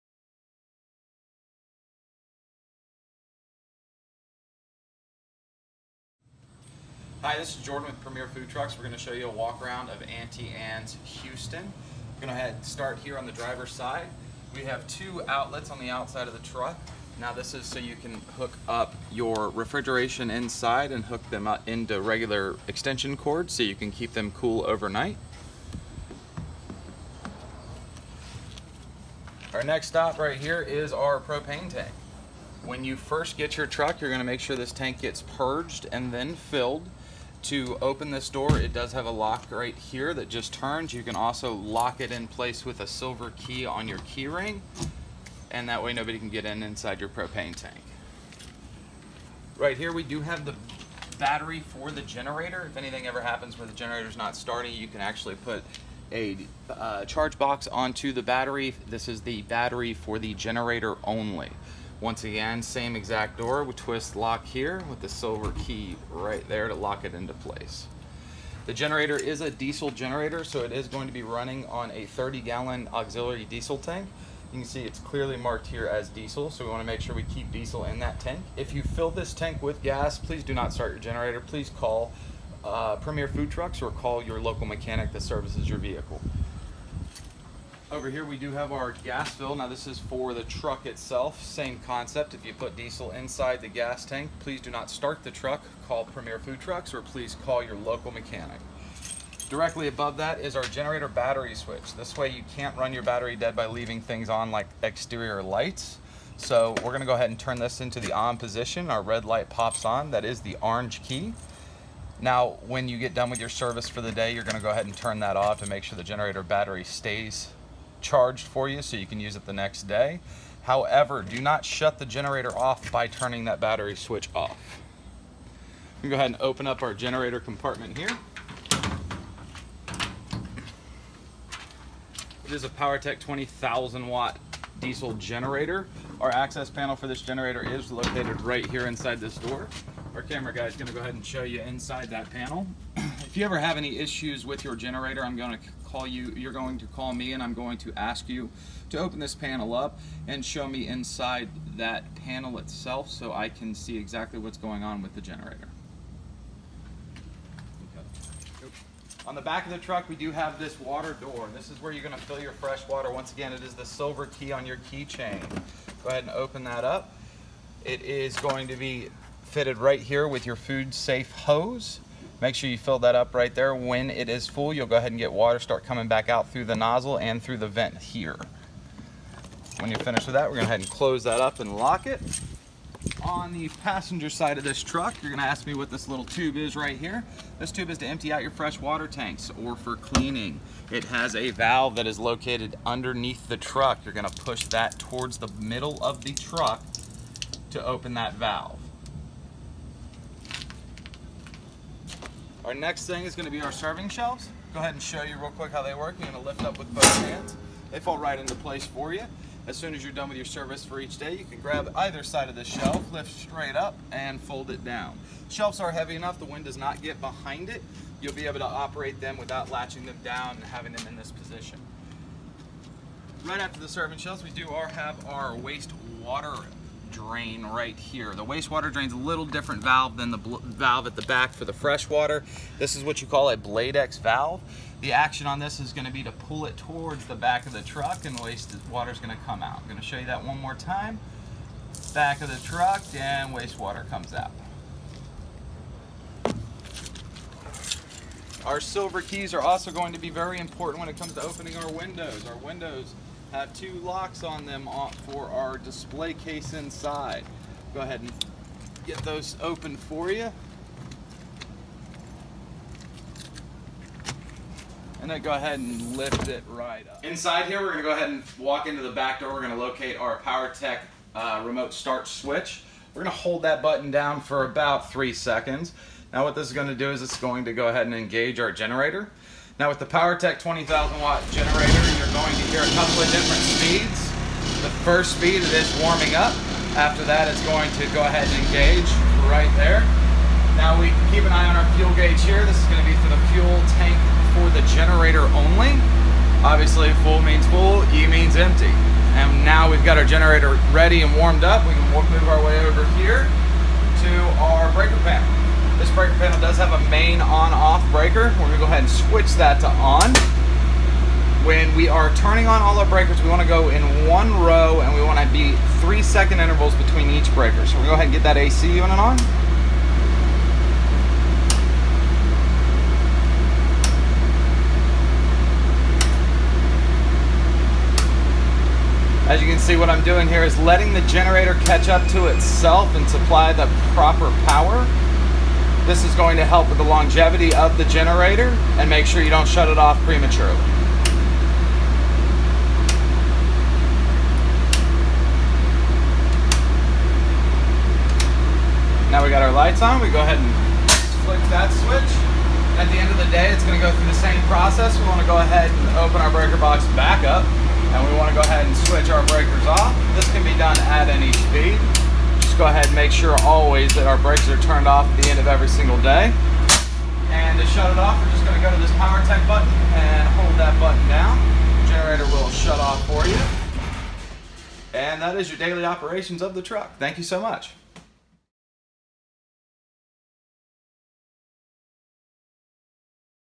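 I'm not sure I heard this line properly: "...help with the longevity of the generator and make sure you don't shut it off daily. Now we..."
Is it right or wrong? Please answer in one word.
wrong.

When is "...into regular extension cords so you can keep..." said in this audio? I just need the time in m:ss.
0:21.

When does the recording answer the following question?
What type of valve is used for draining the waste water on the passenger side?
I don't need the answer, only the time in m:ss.
3:53.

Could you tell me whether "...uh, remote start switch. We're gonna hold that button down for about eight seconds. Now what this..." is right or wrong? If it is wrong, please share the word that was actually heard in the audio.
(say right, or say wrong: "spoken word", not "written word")
wrong: "three", not "eight".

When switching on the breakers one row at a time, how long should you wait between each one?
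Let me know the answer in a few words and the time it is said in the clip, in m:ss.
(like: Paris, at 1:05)
3 seconds, at 5:16.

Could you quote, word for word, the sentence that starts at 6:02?
Just go ahead and make sure always that our brakes are turned off at the end of every single day.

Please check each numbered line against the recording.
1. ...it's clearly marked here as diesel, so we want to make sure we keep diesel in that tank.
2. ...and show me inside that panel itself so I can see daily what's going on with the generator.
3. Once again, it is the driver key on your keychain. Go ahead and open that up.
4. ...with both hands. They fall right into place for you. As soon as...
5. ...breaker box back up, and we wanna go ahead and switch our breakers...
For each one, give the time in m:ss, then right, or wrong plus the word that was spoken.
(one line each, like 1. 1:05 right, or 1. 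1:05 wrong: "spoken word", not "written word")
1. 1:14 right
2. 2:30 wrong: "exactly", not "daily"
3. 2:43 wrong: "silver", not "driver"
4. 3:26 right
5. 5:56 right.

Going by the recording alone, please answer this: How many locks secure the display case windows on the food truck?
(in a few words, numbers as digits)
2.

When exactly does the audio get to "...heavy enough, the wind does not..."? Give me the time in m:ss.
3:35.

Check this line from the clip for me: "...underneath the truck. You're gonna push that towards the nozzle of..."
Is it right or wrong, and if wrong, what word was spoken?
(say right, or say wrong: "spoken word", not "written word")
wrong: "middle", not "nozzle".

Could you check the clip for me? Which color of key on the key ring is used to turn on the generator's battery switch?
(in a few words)
Orange.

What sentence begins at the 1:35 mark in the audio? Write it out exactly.
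Call Premier Food Trucks or please call your local mechanic.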